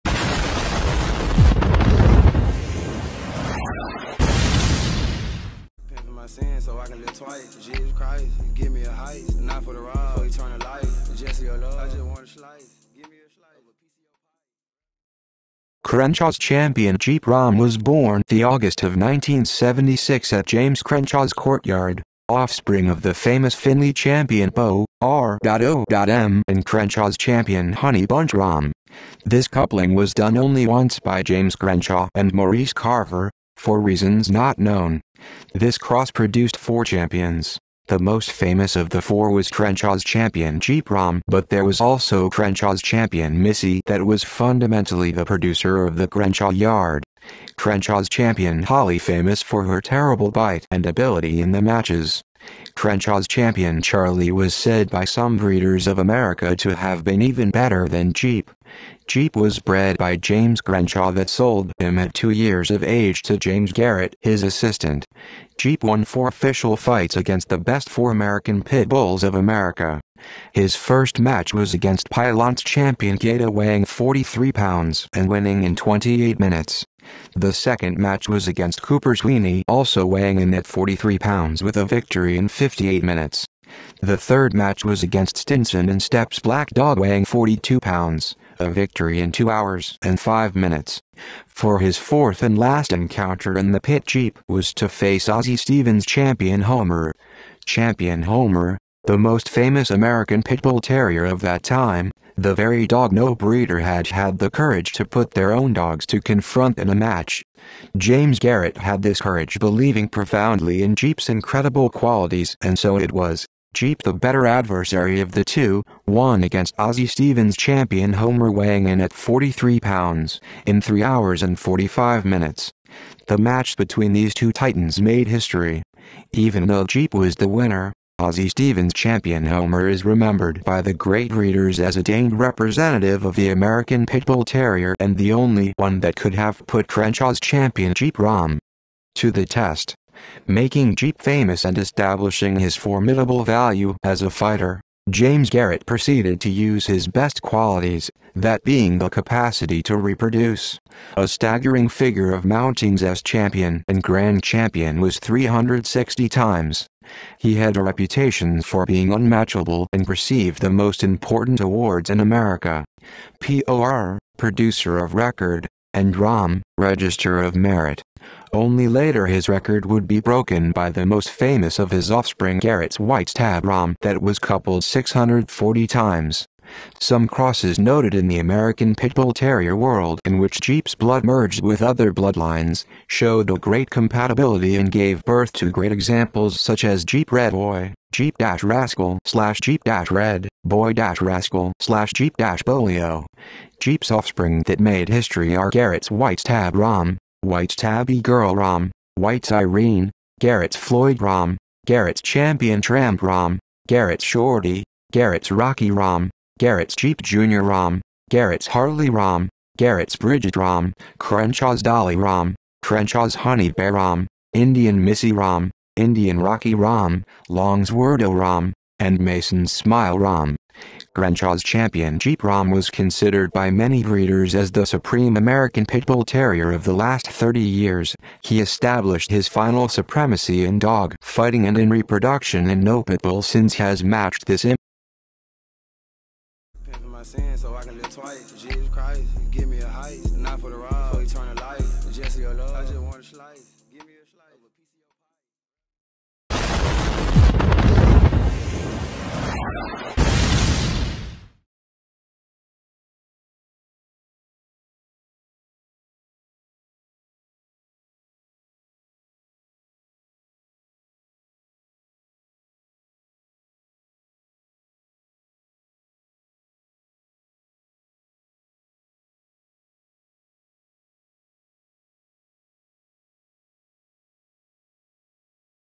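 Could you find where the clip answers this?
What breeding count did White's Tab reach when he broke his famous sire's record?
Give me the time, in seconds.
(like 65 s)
174 s.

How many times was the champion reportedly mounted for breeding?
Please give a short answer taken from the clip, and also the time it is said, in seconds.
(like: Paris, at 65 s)
360, at 155 s.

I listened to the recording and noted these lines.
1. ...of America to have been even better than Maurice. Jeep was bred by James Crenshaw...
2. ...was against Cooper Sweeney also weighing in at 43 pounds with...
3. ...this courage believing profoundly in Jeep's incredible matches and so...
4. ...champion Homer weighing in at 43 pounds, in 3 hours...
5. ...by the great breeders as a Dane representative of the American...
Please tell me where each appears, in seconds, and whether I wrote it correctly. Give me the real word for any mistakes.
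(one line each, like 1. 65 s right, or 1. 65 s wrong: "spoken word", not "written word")
1. 55 s wrong: "Jeep", not "Maurice"
2. 78 s right
3. 109 s wrong: "qualities", not "matches"
4. 117 s right
5. 130 s right.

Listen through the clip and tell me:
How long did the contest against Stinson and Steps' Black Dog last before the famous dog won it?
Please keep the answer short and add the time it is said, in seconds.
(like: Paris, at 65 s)
2 hours and 5 minutes, at 89 s.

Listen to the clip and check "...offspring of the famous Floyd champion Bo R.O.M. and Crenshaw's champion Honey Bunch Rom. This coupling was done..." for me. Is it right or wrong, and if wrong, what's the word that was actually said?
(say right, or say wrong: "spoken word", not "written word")
wrong: "Finley", not "Floyd".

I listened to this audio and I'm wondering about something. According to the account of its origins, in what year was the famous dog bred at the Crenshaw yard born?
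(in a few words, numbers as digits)
1976.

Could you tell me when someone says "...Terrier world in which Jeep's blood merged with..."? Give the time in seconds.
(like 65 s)
179 s.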